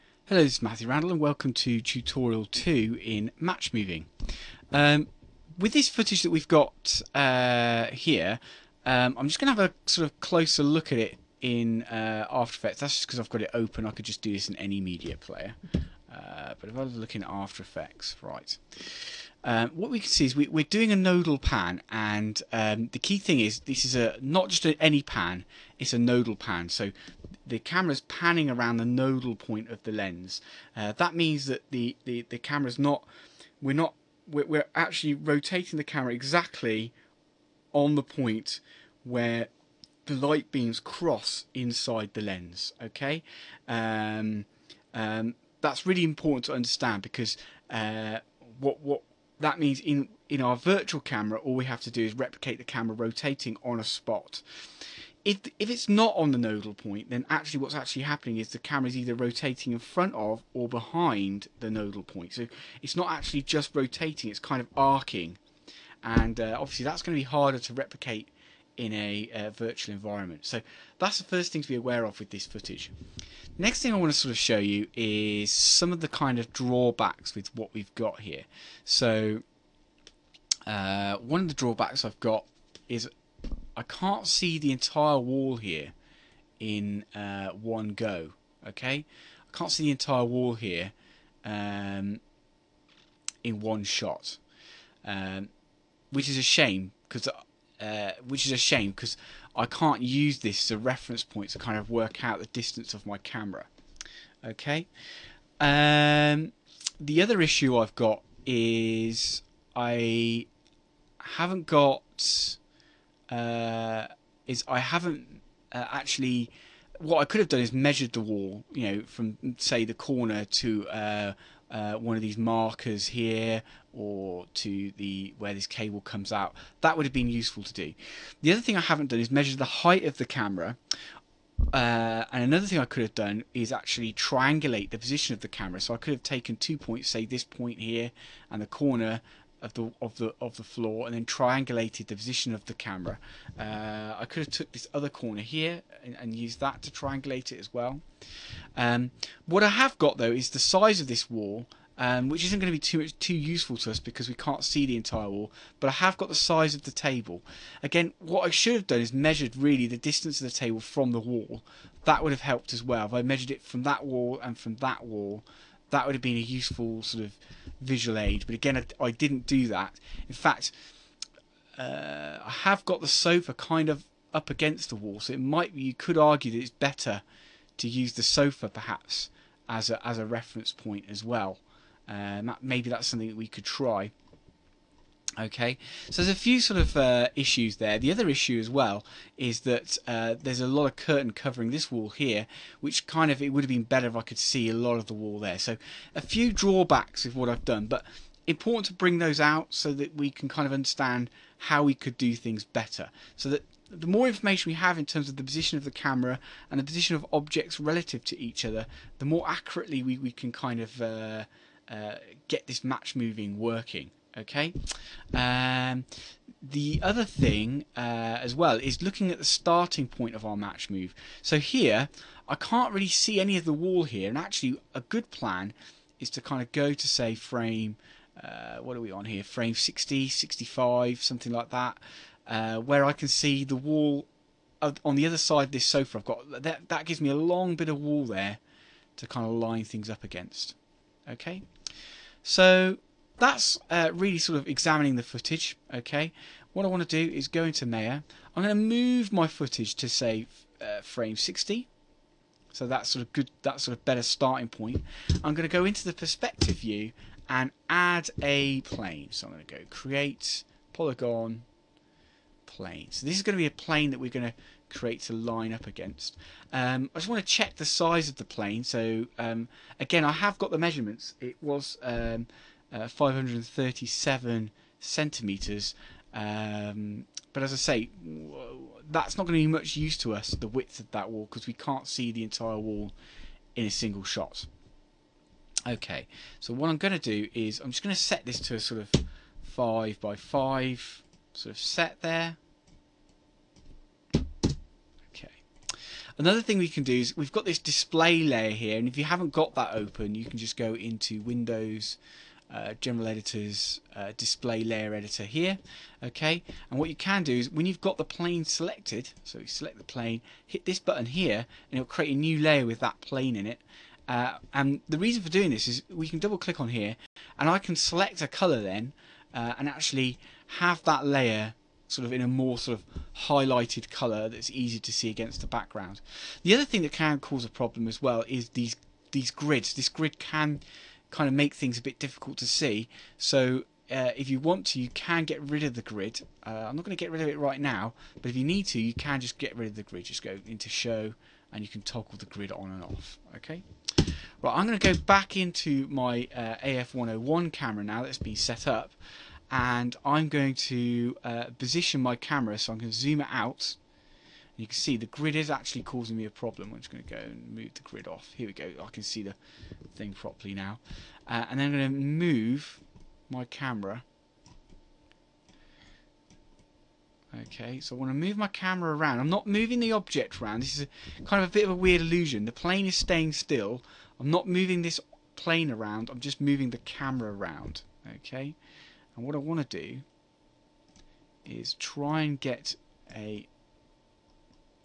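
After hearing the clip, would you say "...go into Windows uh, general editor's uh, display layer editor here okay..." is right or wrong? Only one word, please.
right.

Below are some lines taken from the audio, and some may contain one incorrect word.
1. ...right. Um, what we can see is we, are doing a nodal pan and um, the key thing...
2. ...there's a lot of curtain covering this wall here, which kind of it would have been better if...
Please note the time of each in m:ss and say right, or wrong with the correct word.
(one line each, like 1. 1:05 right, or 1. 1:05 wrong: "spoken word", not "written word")
1. 0:18 right
2. 3:10 right.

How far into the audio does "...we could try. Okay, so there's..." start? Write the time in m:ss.
3:03.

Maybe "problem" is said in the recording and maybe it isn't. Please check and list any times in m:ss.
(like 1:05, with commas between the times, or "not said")
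5:27, 5:56.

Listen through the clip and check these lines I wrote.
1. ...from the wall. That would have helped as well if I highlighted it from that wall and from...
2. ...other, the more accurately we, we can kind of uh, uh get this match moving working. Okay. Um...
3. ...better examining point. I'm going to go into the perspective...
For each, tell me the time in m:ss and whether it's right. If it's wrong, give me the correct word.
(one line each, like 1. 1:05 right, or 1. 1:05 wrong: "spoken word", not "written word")
1. 2:40 wrong: "measured", not "highlighted"
2. 3:28 right
3. 4:14 wrong: "starting", not "examining".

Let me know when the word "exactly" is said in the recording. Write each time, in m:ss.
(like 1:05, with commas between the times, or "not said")
0:36.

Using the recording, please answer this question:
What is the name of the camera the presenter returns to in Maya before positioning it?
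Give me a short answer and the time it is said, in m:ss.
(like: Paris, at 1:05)
AF101, at 5:46.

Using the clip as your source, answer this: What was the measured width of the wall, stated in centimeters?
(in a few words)
537 centimeters.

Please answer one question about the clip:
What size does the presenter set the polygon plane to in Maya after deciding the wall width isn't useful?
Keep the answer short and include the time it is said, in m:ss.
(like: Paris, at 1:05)
5 by 5, at 4:49.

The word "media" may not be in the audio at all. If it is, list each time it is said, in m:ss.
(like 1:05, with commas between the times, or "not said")
0:14.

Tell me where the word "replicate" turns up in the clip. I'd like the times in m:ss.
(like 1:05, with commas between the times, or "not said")
0:52, 1:07.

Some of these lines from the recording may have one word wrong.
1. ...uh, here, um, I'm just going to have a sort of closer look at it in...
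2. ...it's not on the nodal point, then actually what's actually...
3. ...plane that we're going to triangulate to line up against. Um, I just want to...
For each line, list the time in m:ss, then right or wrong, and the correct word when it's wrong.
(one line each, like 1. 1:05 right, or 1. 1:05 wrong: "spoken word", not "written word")
1. 0:07 right
2. 0:55 right
3. 4:23 wrong: "create", not "triangulate".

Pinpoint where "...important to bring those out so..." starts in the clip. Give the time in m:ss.
3:18.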